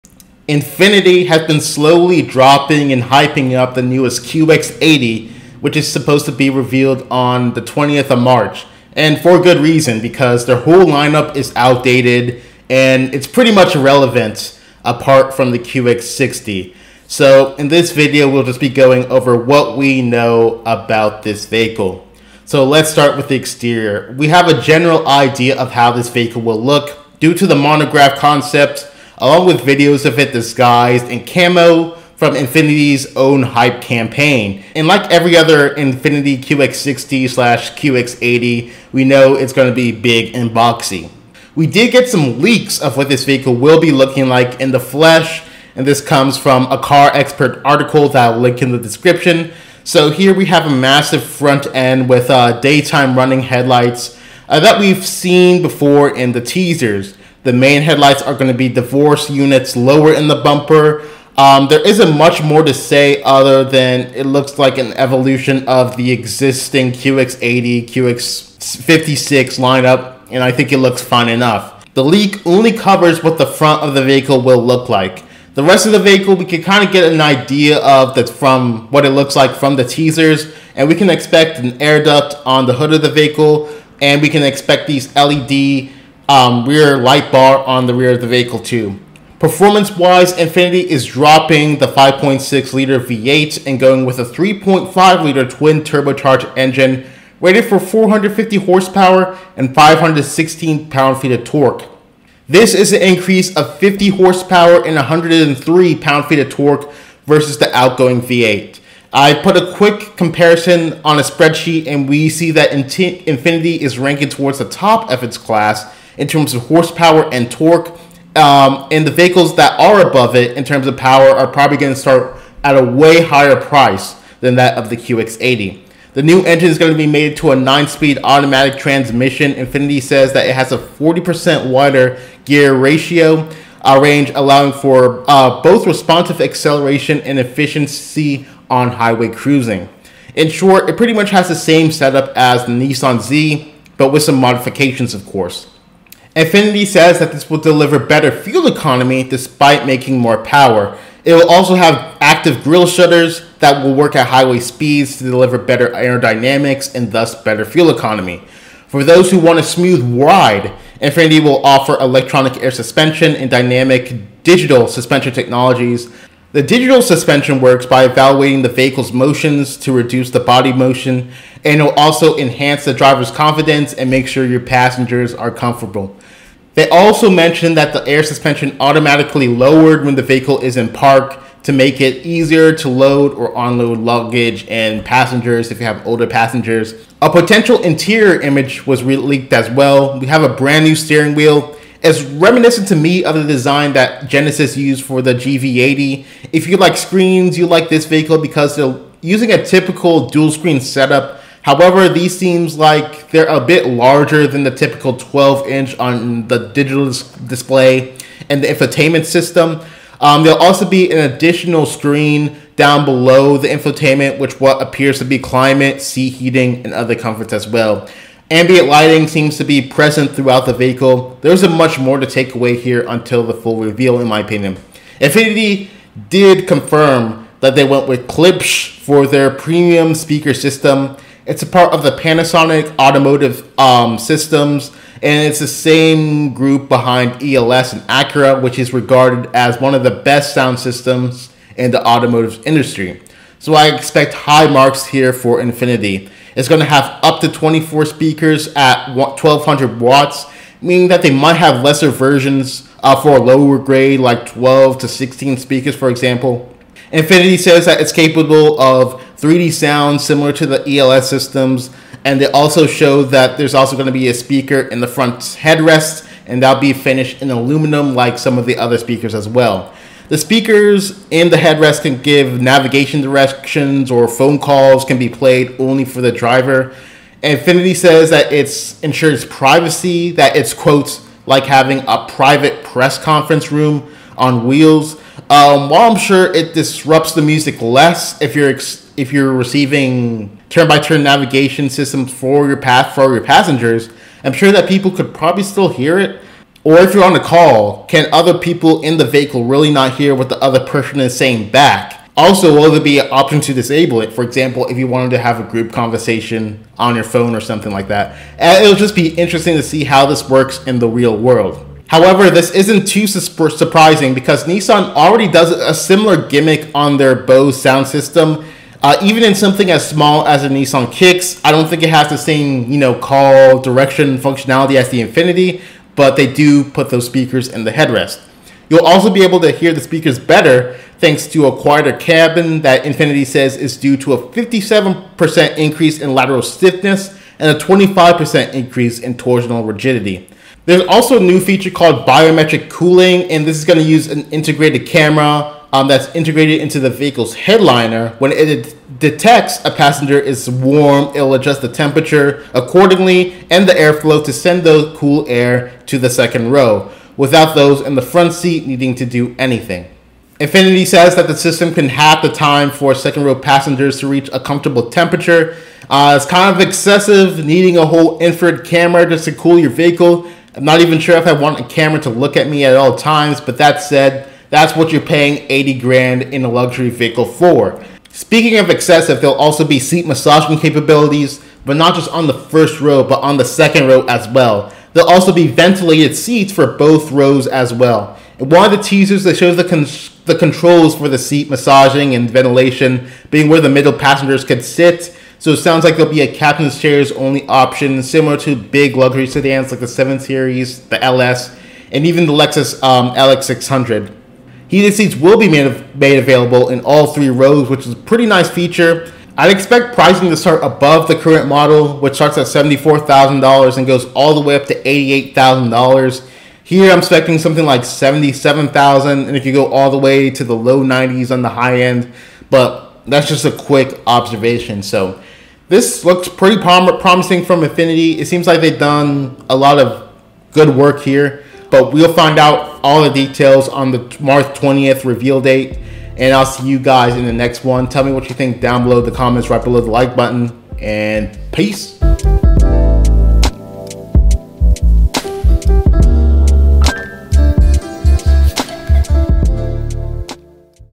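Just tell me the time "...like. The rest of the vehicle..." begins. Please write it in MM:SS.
01:14.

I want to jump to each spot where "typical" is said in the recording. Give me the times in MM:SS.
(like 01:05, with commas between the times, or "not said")
03:19, 03:24.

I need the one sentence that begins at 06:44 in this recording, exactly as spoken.
Heated seats will be made, made available in all three rows, which is a pretty nice feature.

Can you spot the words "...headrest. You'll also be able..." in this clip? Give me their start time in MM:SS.
05:27.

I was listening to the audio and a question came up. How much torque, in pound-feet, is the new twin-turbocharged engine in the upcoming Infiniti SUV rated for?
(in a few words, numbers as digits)
516.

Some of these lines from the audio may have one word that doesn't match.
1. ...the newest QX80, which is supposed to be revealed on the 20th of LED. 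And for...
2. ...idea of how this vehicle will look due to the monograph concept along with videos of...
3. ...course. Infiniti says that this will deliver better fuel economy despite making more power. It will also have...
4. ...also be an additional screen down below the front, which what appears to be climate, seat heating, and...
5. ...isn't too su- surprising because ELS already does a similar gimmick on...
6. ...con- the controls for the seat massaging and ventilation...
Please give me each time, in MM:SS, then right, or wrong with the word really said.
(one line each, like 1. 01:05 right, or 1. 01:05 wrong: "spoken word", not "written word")
1. 00:03 wrong: "March", not "LED"
2. 00:25 right
3. 02:25 right
4. 03:30 wrong: "infotainment", not "front"
5. 05:12 wrong: "Nissan", not "ELS"
6. 06:29 right.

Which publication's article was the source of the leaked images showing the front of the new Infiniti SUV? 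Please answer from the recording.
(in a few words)
CarExpert.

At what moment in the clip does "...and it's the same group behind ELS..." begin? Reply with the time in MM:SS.
03:55.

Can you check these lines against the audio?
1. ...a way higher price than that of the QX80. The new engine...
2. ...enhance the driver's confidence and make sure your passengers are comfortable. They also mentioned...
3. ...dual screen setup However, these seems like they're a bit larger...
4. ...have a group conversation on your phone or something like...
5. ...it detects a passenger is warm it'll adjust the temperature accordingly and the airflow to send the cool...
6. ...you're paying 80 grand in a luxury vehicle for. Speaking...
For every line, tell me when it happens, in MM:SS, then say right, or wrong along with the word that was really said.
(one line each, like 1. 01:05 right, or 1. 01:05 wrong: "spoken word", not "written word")
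1. 02:02 right
2. 02:52 right
3. 03:20 right
4. 05:05 right
5. 05:48 right
6. 06:15 right.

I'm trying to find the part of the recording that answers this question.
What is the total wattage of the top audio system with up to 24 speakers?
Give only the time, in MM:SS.
04:09.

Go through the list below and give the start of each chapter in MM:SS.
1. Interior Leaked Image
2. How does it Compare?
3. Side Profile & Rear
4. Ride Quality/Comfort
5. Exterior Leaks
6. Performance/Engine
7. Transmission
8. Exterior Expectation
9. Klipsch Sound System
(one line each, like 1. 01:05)
1. 03:07
2. 01:50
3. 01:18
4. 02:40
5. 00:50
6. 01:30
7. 02:06
8. 00:23
9. 03:48.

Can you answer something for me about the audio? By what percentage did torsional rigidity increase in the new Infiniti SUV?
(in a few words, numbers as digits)
25%.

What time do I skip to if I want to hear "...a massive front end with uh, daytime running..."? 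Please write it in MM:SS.
00:50.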